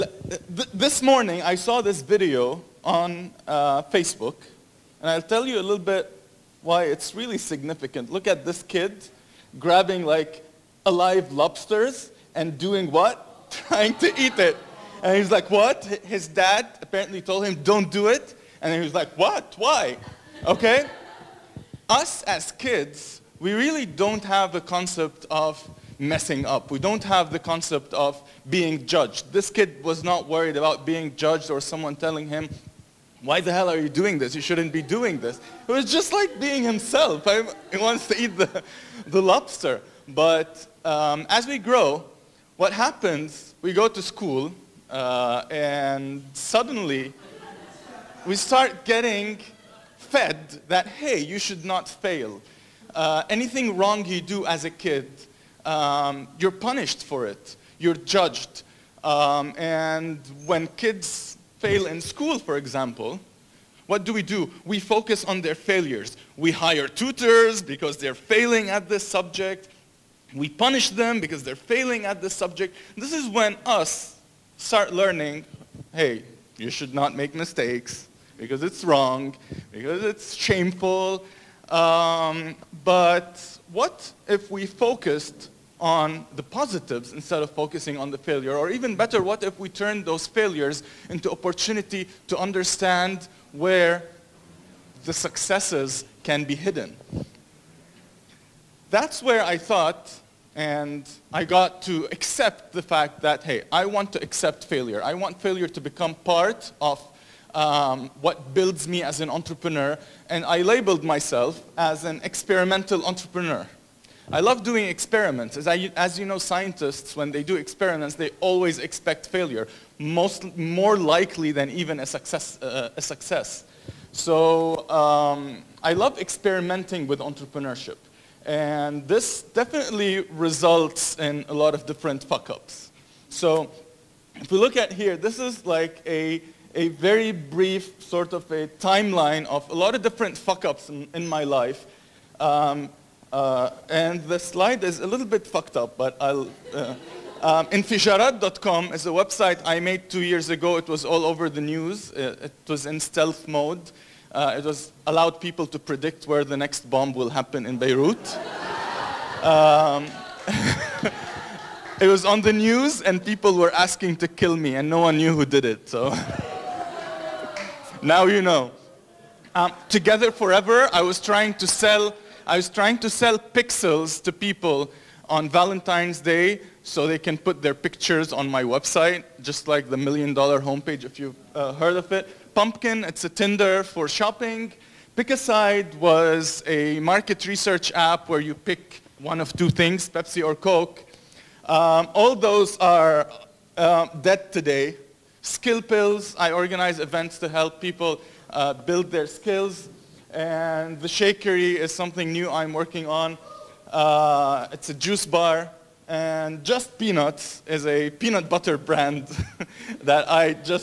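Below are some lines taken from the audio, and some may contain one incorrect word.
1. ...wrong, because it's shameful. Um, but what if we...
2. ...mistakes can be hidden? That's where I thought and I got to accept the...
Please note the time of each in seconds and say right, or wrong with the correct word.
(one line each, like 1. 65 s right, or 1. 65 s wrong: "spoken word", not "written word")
1. 78 s right
2. 95 s wrong: "successes", not "mistakes".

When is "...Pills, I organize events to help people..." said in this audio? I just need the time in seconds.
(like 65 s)
195 s.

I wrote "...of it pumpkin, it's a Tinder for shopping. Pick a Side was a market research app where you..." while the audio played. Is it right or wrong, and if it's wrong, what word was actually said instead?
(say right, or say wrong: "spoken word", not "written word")
right.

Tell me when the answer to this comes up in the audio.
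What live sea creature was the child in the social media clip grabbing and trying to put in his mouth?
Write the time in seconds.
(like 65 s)
11 s.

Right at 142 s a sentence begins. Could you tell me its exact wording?
Um, uh, and the slide is a little bit fucked up, but I'll...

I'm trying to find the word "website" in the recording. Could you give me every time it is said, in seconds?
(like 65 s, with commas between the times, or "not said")
149 s, 178 s.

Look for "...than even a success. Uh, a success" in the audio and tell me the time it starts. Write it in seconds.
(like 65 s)
121 s.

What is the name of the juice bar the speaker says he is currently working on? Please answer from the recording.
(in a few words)
The Shakery.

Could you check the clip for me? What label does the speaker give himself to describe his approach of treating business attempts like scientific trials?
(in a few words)
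Experimental entrepreneur.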